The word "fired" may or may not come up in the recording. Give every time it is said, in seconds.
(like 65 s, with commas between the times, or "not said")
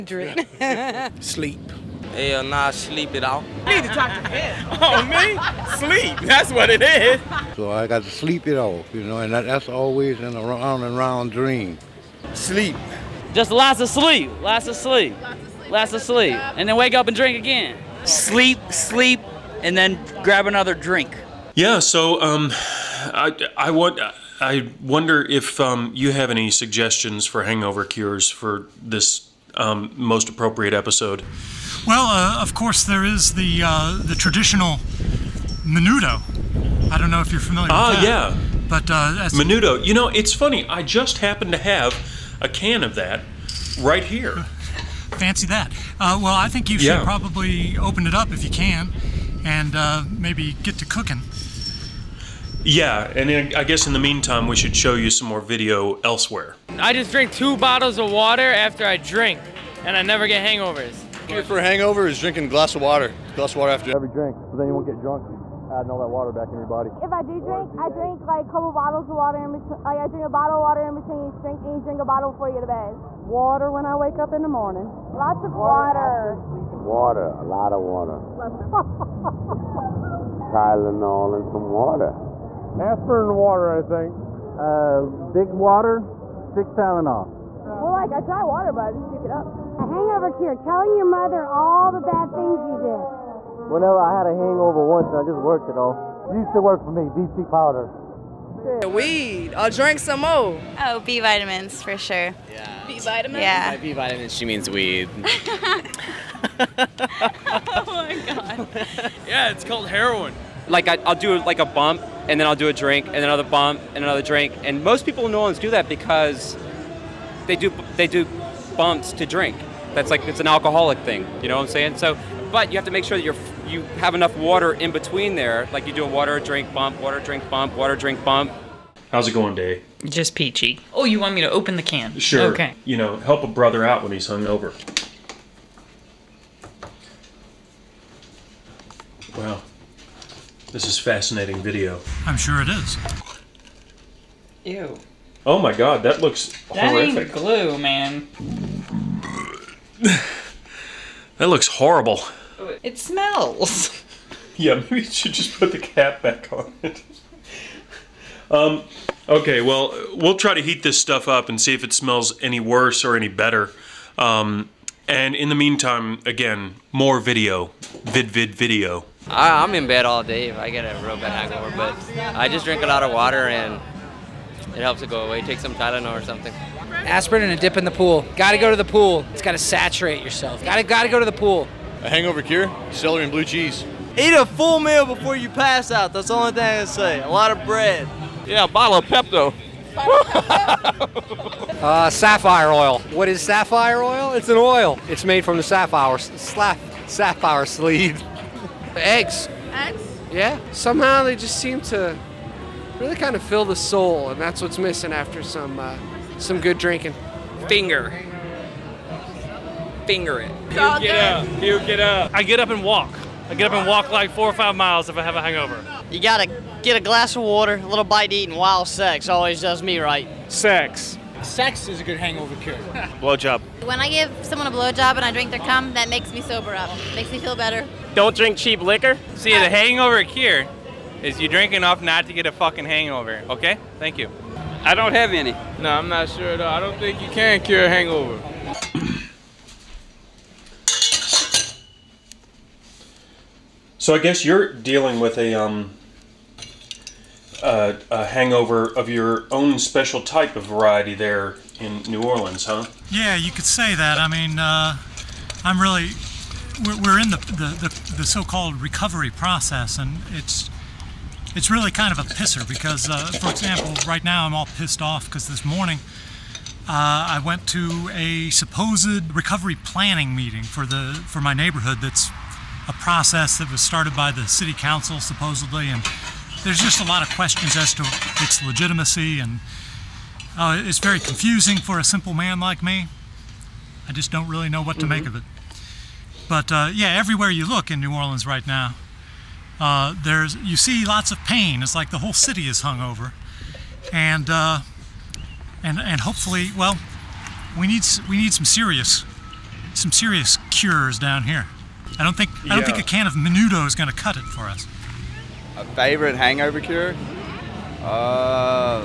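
not said.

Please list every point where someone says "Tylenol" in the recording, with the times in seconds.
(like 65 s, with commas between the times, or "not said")
80 s, 86 s, 175 s.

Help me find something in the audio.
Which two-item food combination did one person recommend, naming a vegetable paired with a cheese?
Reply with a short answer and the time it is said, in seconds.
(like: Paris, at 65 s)
celery and blue cheese, at 182 s.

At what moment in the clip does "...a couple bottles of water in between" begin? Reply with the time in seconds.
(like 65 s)
68 s.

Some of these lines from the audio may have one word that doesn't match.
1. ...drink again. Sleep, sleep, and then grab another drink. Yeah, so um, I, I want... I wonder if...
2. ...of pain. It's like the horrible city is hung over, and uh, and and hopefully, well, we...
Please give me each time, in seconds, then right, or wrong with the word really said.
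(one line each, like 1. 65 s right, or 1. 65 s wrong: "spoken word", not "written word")
1. 17 s right
2. 291 s wrong: "whole", not "horrible".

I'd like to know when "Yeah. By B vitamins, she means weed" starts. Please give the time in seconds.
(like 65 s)
103 s.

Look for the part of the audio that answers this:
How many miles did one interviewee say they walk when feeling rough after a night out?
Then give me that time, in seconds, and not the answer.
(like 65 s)
214 s.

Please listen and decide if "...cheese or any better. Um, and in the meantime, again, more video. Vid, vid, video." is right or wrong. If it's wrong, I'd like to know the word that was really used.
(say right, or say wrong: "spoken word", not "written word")
wrong: "worse", not "cheese".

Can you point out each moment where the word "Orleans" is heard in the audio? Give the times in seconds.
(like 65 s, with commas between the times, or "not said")
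115 s, 252 s, 288 s.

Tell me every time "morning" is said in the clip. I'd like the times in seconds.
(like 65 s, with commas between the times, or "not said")
74 s, 265 s.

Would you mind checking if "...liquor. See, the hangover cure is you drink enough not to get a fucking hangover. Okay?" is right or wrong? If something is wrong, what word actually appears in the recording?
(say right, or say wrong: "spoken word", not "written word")
right.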